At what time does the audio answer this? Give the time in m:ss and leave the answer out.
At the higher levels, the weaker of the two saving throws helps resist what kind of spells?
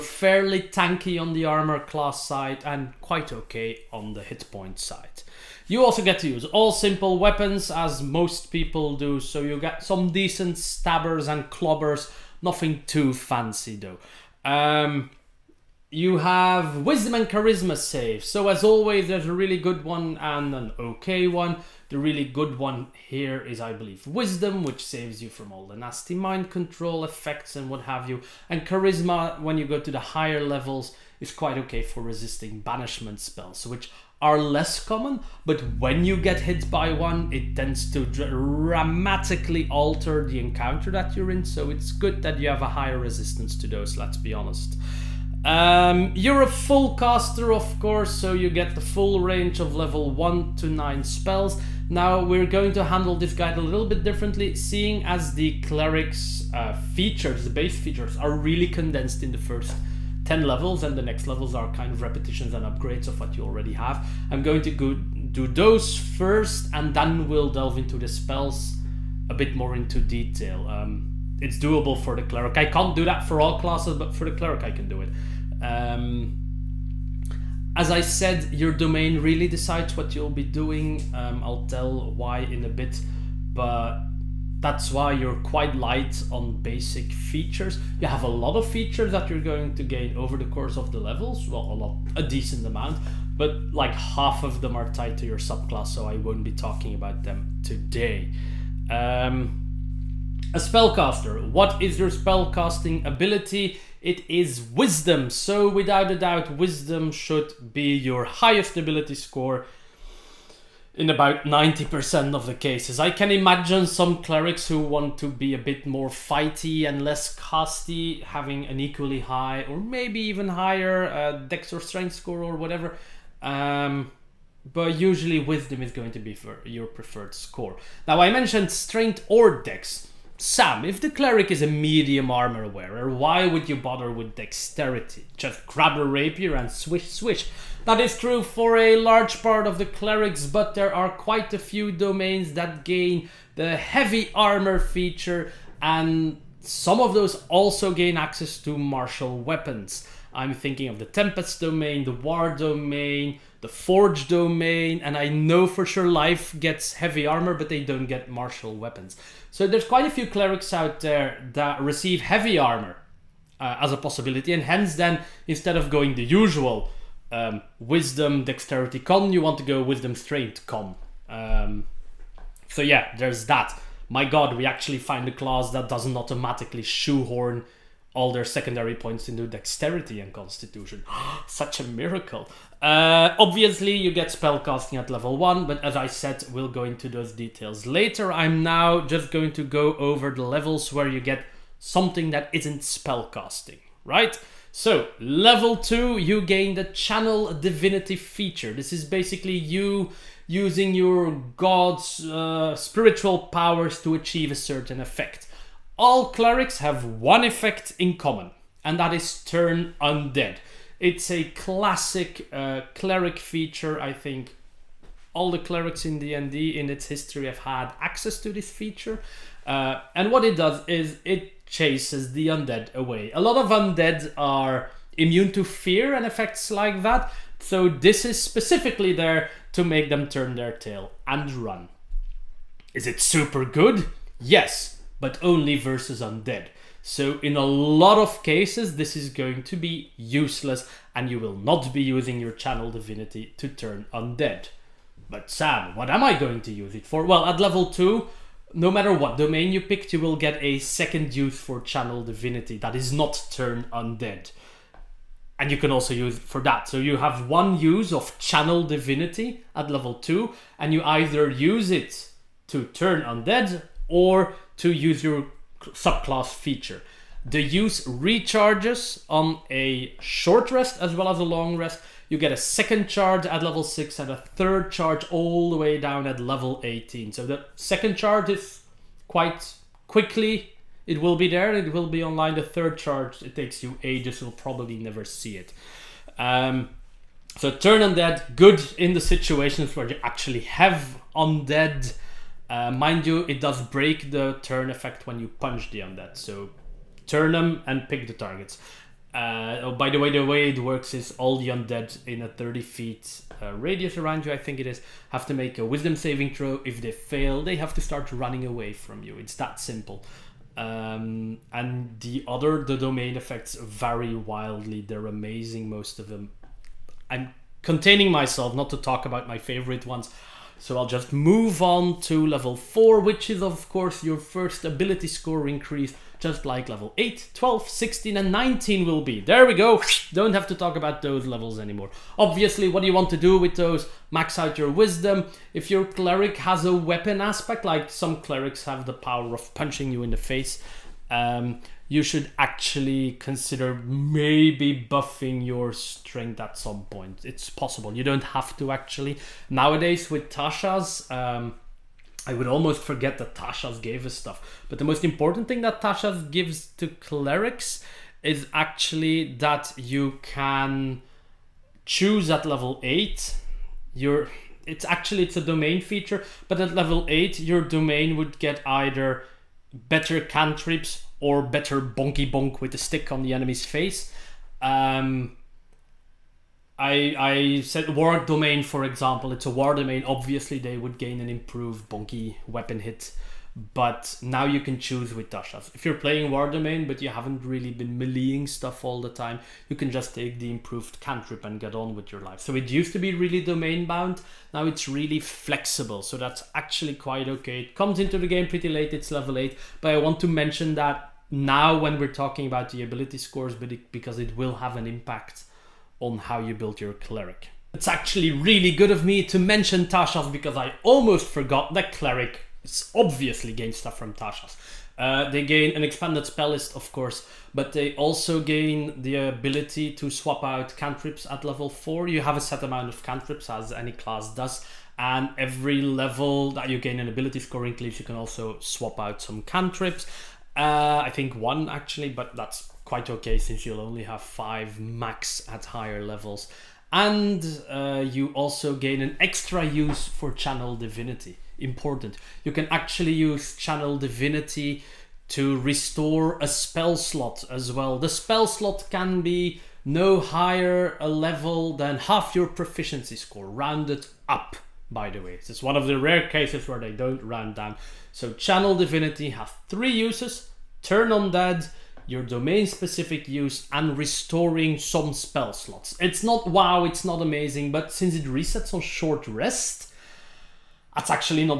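0:32.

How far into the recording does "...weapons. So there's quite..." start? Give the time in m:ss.
2:38.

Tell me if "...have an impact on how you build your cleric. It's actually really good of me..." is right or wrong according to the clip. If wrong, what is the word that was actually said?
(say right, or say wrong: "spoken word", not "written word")
right.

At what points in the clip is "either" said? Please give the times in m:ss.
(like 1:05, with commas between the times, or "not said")
4:21, 6:08.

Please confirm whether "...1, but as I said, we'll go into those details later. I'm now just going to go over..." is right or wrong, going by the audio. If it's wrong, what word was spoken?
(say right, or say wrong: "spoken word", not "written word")
right.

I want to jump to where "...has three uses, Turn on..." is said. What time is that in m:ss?
7:39.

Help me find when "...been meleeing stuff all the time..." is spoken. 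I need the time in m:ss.
6:27.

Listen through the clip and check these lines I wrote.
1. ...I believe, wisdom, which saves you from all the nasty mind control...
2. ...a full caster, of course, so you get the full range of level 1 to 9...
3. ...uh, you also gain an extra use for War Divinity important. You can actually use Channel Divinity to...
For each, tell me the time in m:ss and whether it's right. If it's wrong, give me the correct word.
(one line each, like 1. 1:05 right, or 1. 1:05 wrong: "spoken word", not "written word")
1. 0:23 right
2. 0:46 right
3. 7:17 wrong: "Channel", not "War".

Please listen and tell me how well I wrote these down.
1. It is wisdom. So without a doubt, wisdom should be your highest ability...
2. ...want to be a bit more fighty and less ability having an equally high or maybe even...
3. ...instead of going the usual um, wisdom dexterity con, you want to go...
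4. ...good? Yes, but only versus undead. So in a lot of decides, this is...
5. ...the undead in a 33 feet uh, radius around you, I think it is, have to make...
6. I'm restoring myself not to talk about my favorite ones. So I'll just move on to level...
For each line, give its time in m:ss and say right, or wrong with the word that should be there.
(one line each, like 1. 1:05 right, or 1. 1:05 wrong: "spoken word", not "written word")
1. 1:44 right
2. 1:54 wrong: "casty", not "ability"
3. 2:45 right
4. 3:53 wrong: "cases", not "decides"
5. 5:01 wrong: "30", not "33"
6. 5:17 wrong: "containing", not "restoring".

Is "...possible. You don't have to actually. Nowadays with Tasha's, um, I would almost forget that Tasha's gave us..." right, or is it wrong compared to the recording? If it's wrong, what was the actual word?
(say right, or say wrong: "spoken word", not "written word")
right.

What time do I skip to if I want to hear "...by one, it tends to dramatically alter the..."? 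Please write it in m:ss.
0:36.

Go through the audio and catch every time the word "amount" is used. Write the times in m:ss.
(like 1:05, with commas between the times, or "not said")
1:32, 7:02.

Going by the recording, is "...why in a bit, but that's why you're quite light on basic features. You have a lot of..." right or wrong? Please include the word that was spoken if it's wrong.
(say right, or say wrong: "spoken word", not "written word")
right.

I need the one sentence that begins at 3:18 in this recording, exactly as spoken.
This is basically you using your god's uh, spiritual powers to achieve a certain effect.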